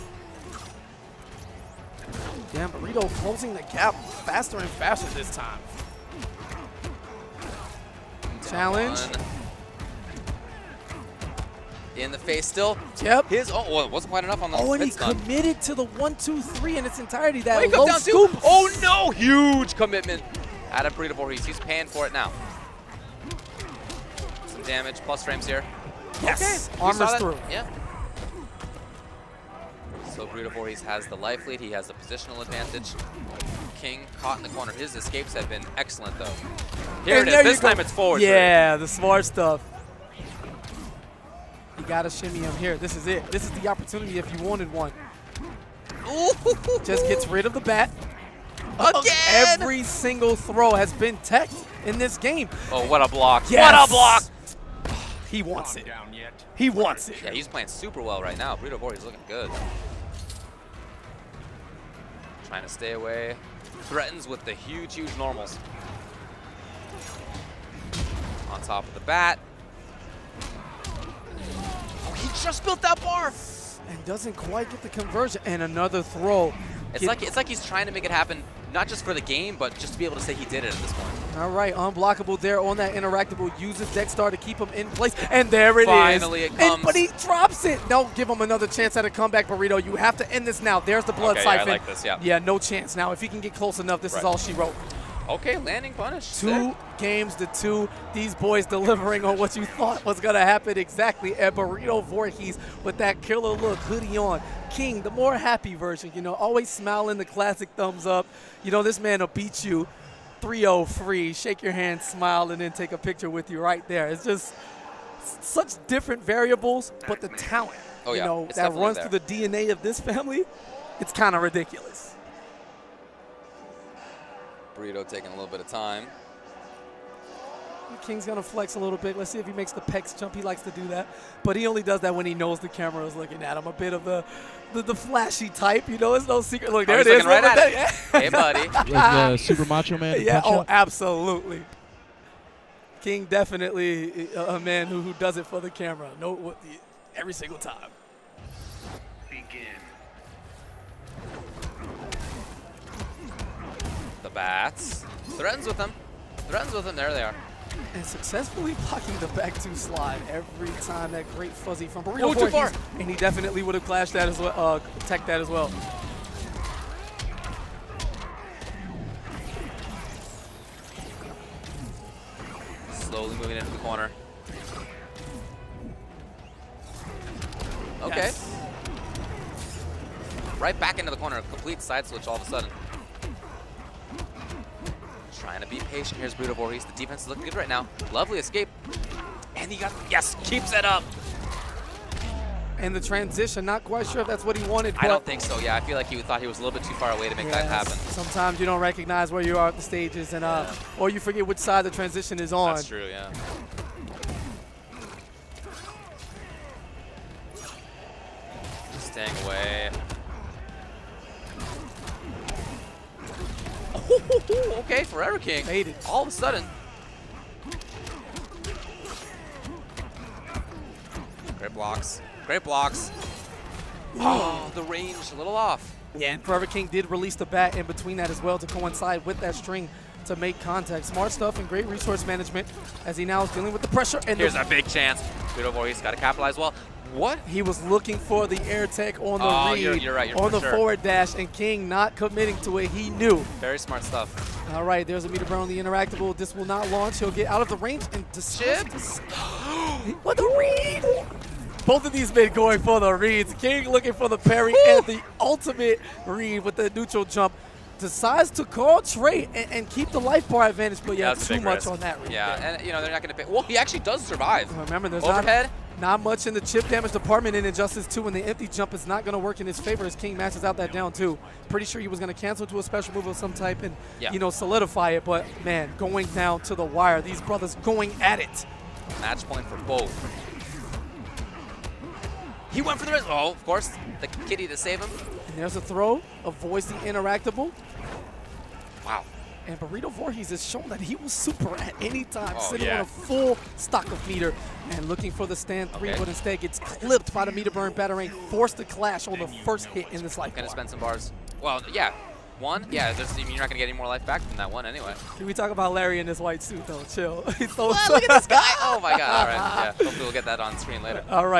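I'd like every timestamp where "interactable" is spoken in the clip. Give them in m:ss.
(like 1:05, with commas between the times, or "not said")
1:22, 4:05, 4:46.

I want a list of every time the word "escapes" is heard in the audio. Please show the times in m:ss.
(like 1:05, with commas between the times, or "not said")
0:34, 3:08.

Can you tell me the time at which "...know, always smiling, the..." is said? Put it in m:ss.
1:46.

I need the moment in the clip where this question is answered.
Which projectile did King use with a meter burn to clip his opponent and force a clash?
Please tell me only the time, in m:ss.
4:57.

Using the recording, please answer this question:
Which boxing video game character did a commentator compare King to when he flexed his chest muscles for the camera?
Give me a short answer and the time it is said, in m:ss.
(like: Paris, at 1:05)
Super Macho Man, at 2:19.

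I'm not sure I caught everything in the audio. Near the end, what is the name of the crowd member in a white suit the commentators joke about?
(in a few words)
Larry.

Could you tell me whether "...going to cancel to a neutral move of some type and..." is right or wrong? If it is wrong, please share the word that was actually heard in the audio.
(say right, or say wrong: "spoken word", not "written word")
wrong: "special", not "neutral".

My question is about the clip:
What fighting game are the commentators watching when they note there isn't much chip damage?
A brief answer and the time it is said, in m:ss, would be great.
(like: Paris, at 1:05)
Injustice 2, at 4:27.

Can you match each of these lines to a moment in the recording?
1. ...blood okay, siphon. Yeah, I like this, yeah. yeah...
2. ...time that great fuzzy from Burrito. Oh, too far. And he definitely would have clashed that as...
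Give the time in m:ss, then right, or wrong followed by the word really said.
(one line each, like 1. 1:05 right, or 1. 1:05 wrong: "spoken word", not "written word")
1. 1:31 right
2. 2:40 right.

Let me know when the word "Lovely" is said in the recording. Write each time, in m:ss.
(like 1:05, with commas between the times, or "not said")
3:08.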